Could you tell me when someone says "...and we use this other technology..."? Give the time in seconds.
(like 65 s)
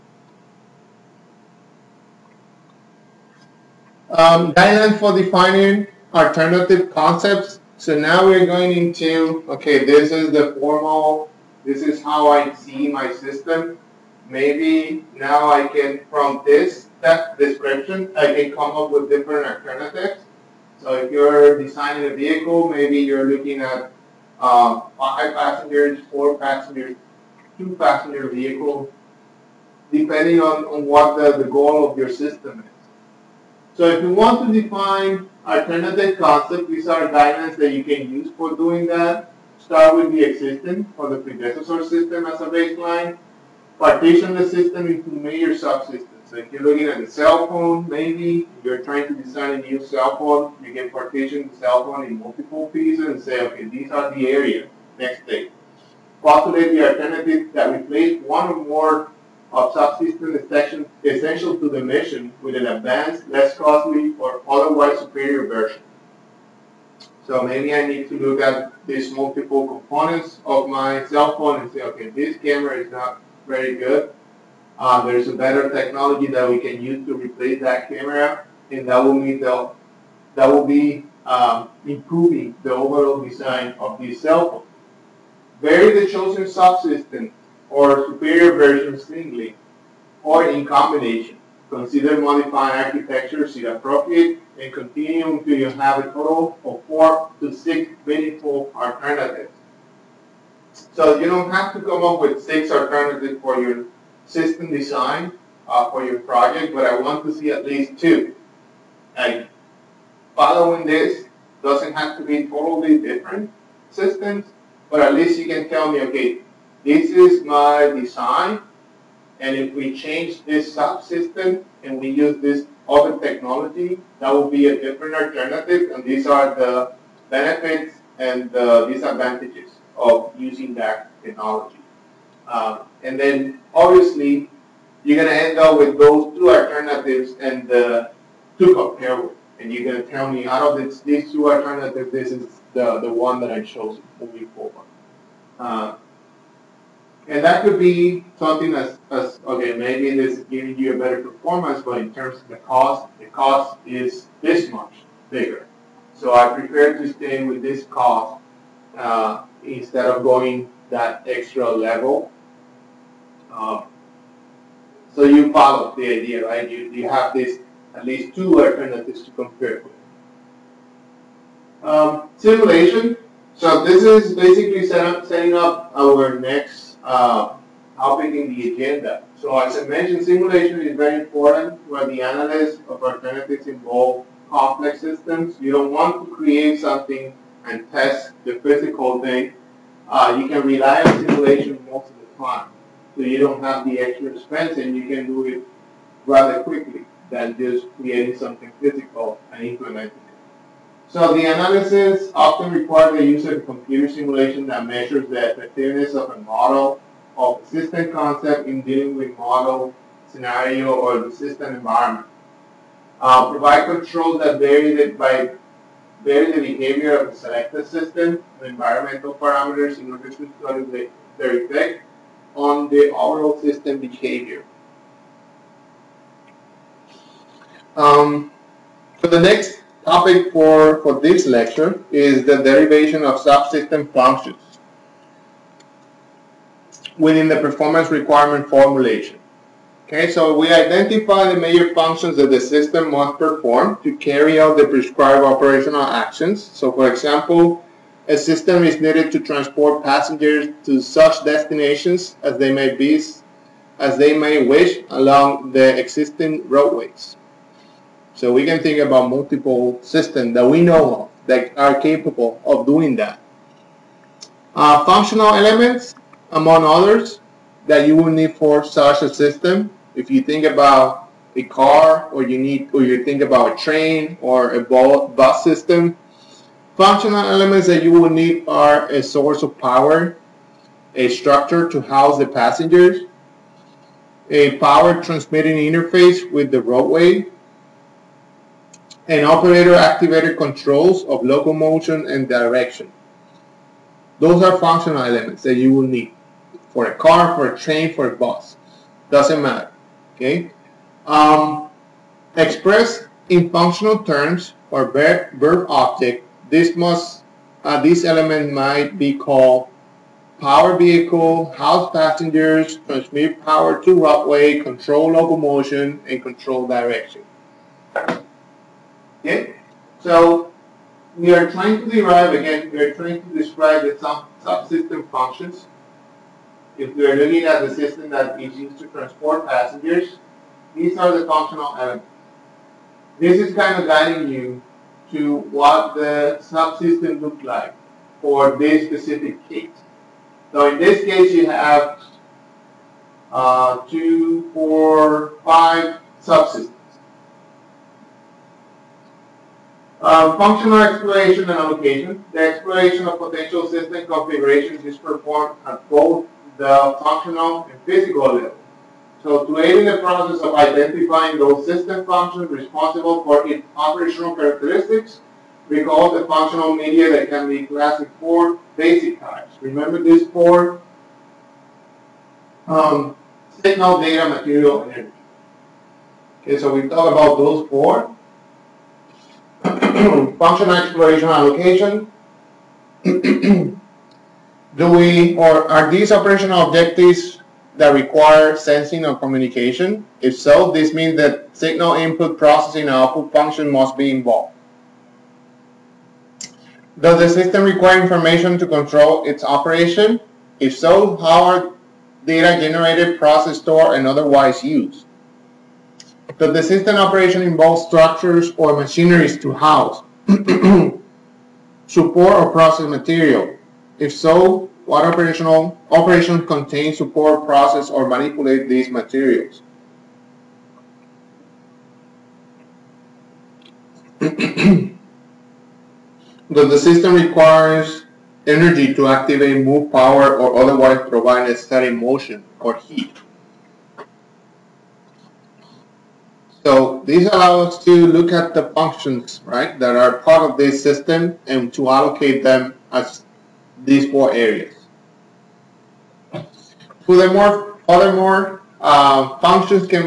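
121 s.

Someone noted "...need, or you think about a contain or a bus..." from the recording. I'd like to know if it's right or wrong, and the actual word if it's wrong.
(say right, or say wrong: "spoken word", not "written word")
wrong: "train", not "contain".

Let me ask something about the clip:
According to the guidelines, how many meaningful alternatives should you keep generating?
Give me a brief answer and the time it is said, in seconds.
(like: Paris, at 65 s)
4 to 6, at 96 s.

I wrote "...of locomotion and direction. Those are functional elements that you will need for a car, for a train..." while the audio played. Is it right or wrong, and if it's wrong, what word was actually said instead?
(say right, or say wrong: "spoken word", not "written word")
right.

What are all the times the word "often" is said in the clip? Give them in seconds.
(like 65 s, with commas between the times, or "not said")
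202 s.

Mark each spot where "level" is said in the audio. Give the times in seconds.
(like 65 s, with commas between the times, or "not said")
161 s, 358 s.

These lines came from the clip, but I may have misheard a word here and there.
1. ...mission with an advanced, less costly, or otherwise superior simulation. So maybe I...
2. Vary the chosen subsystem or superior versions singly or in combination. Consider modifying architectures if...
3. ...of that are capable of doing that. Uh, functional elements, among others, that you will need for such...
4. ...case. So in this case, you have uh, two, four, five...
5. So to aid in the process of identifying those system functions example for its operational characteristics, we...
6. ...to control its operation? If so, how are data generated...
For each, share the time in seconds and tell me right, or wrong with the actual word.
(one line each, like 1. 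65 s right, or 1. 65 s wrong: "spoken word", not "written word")
1. 61 s wrong: "version", not "simulation"
2. 85 s right
3. 261 s right
4. 339 s right
5. 359 s wrong: "responsible", not "example"
6. 398 s right.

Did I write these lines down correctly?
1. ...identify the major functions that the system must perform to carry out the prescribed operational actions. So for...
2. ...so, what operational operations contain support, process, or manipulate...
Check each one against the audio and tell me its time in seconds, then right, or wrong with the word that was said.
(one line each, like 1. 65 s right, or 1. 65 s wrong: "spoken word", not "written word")
1. 240 s right
2. 414 s right.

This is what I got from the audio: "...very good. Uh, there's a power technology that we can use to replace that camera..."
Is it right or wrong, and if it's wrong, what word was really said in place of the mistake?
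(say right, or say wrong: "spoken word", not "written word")
wrong: "better", not "power".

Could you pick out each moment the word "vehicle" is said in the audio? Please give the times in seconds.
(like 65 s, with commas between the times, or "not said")
22 s, 28 s, 310 s.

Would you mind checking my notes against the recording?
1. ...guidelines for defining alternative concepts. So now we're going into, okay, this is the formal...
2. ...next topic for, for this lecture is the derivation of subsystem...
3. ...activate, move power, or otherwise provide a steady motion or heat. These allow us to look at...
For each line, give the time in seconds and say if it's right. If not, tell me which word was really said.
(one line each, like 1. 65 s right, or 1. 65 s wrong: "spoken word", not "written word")
1. 4 s right
2. 229 s right
3. 429 s right.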